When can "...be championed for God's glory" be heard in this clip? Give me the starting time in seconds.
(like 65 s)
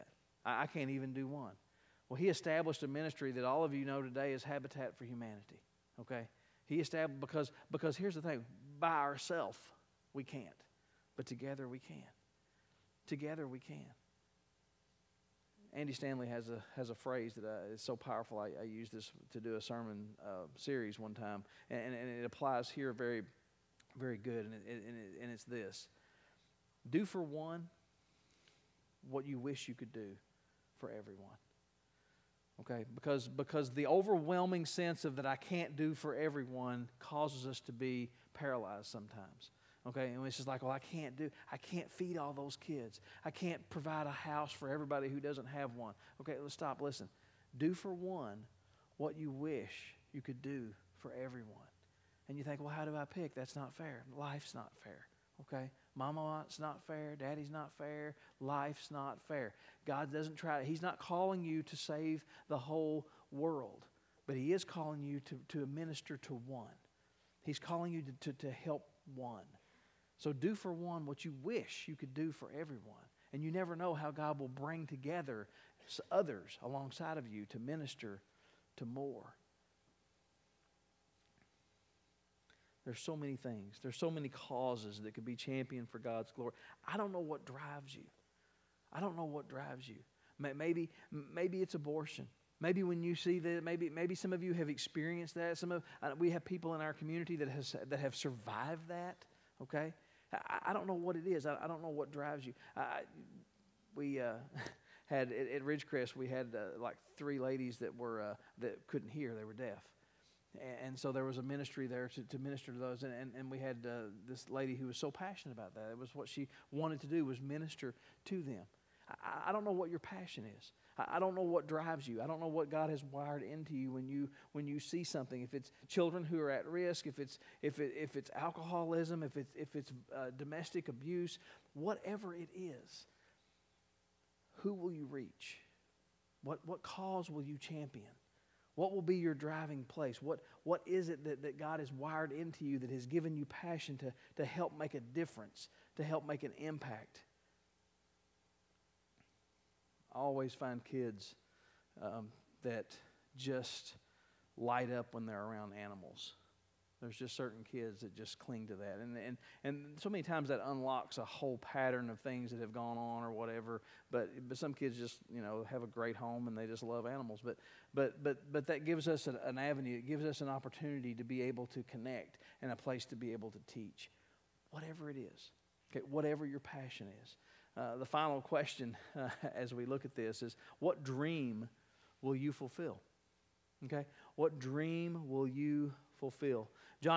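85 s.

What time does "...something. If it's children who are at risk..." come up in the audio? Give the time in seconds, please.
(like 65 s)
125 s.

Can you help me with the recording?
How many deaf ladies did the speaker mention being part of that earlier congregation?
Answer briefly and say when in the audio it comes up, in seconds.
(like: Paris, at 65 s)
3, at 107 s.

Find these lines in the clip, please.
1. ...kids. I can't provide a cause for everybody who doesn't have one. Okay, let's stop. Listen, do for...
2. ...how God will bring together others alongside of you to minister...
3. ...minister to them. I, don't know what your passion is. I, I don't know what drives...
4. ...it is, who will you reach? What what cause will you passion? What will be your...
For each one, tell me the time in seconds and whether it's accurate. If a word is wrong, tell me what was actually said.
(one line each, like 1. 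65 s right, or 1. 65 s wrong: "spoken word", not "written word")
1. 42 s wrong: "house", not "cause"
2. 73 s right
3. 117 s right
4. 132 s wrong: "champion", not "passion".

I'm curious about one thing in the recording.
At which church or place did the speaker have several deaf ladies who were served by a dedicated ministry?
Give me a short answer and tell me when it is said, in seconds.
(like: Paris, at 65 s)
Ridgecrest, at 105 s.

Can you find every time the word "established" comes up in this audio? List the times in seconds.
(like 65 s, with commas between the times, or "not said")
2 s, 6 s.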